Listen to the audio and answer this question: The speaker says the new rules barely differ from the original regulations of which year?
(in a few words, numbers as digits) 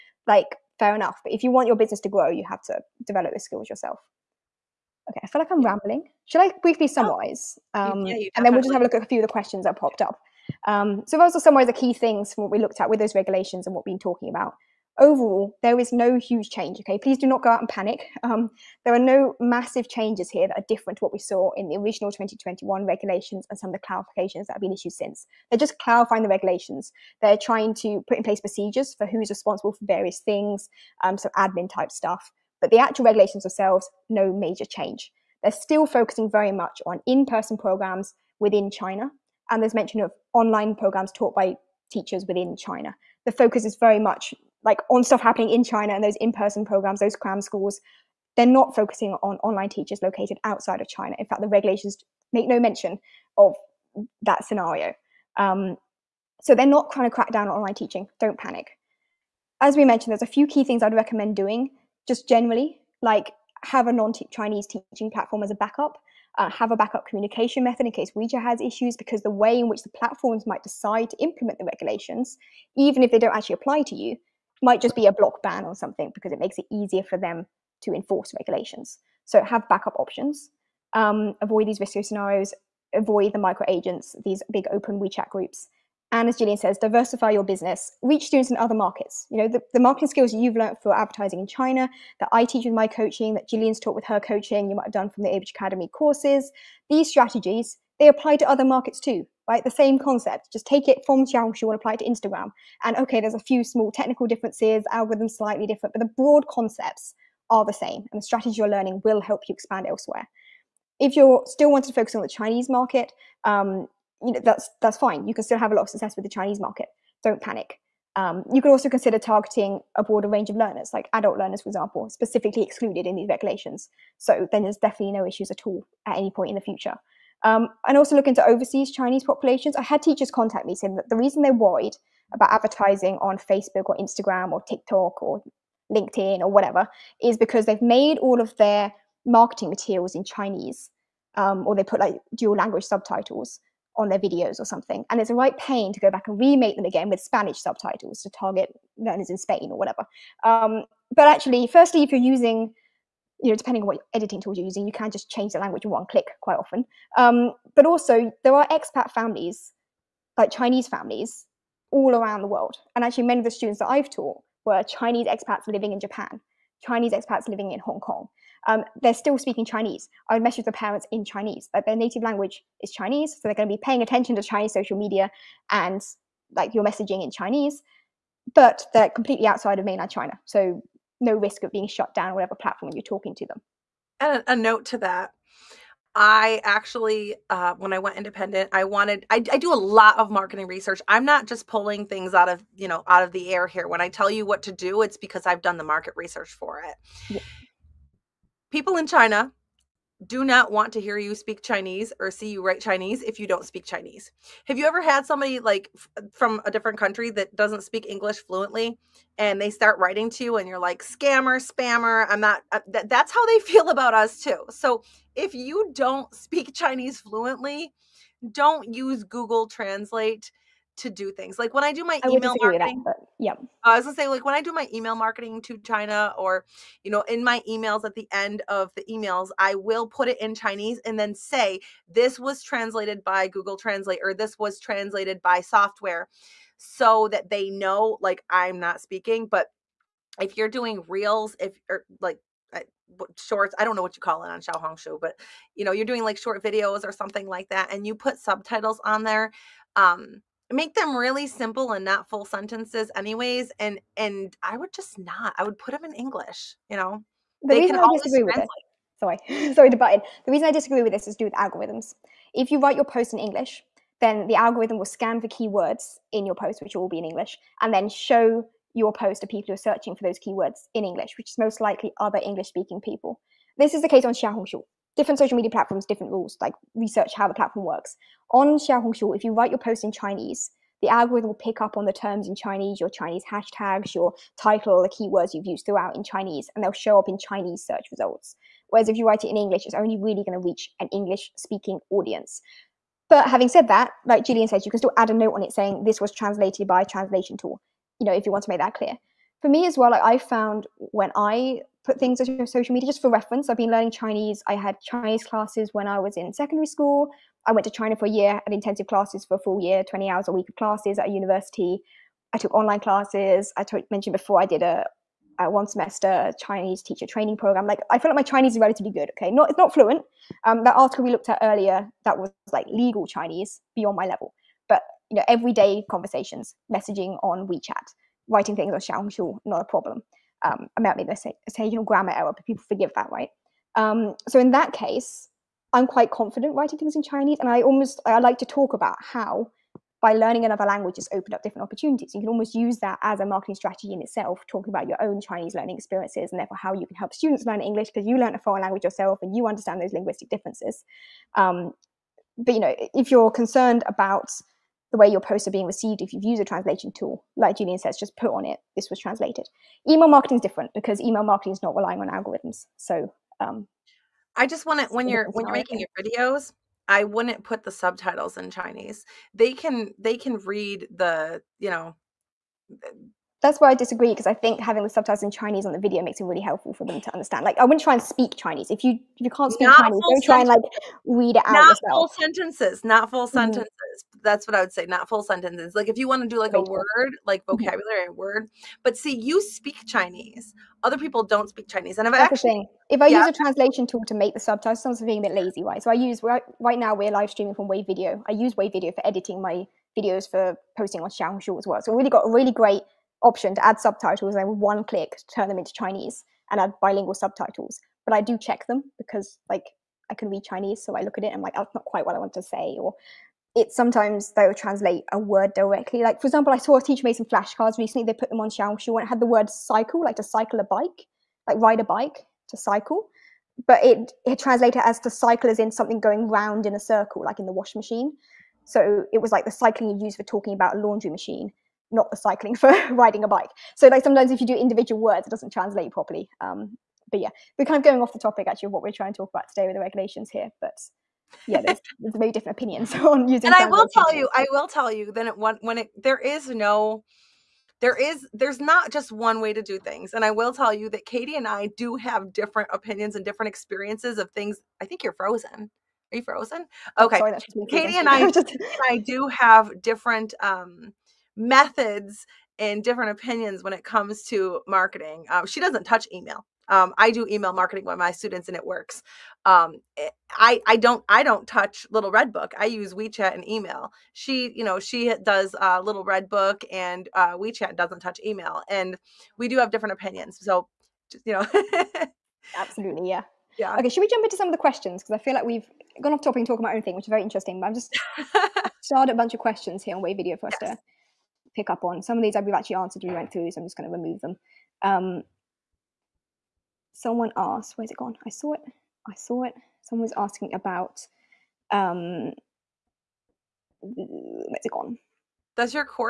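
2021.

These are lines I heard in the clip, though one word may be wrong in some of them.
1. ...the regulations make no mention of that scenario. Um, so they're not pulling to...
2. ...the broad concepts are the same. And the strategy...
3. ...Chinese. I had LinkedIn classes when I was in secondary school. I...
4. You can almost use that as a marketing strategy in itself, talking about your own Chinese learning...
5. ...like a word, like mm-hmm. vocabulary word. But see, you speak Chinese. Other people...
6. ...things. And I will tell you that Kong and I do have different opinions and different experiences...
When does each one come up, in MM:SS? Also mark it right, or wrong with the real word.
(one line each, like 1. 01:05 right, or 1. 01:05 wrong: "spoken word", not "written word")
1. 00:51 wrong: "trying", not "pulling"
2. 01:46 right
3. 05:04 wrong: "Chinese", not "LinkedIn"
4. 05:42 right
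5. 06:26 right
6. 07:29 wrong: "Katie", not "Kong".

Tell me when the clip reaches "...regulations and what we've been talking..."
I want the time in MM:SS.
00:13.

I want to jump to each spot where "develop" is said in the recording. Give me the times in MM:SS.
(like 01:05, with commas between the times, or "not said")
00:03.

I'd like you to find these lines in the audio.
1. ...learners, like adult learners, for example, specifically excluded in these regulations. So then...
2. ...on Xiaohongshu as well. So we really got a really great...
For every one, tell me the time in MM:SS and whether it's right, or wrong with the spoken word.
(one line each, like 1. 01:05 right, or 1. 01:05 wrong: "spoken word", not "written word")
1. 02:00 right
2. 06:41 right.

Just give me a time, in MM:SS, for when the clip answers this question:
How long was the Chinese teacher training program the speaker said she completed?
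05:15.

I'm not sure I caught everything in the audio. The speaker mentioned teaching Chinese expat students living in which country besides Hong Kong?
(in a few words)
Japan.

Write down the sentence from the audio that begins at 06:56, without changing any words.
Like for example, I saw a teacher made some flashcards recently.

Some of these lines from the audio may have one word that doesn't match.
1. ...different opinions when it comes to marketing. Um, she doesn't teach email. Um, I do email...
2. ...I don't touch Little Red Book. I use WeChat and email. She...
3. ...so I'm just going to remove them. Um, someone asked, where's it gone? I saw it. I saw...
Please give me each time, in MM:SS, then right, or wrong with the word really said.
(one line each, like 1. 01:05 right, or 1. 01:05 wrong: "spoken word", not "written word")
1. 07:43 wrong: "touch", not "teach"
2. 07:51 right
3. 08:13 right.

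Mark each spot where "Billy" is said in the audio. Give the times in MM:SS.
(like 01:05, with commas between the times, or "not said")
not said.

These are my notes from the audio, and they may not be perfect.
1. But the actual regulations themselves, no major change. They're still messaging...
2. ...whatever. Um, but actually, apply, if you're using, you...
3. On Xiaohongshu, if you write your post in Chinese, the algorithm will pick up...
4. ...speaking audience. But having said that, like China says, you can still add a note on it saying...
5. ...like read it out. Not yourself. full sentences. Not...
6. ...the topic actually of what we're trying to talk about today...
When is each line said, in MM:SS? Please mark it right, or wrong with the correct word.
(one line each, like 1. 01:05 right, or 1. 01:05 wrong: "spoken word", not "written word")
1. 00:32 wrong: "focusing", not "messaging"
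2. 02:29 wrong: "firstly", not "apply"
3. 04:38 right
4. 04:51 wrong: "Jillian", not "China"
5. 06:20 right
6. 07:18 right.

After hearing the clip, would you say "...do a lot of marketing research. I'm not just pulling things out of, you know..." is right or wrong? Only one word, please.
right.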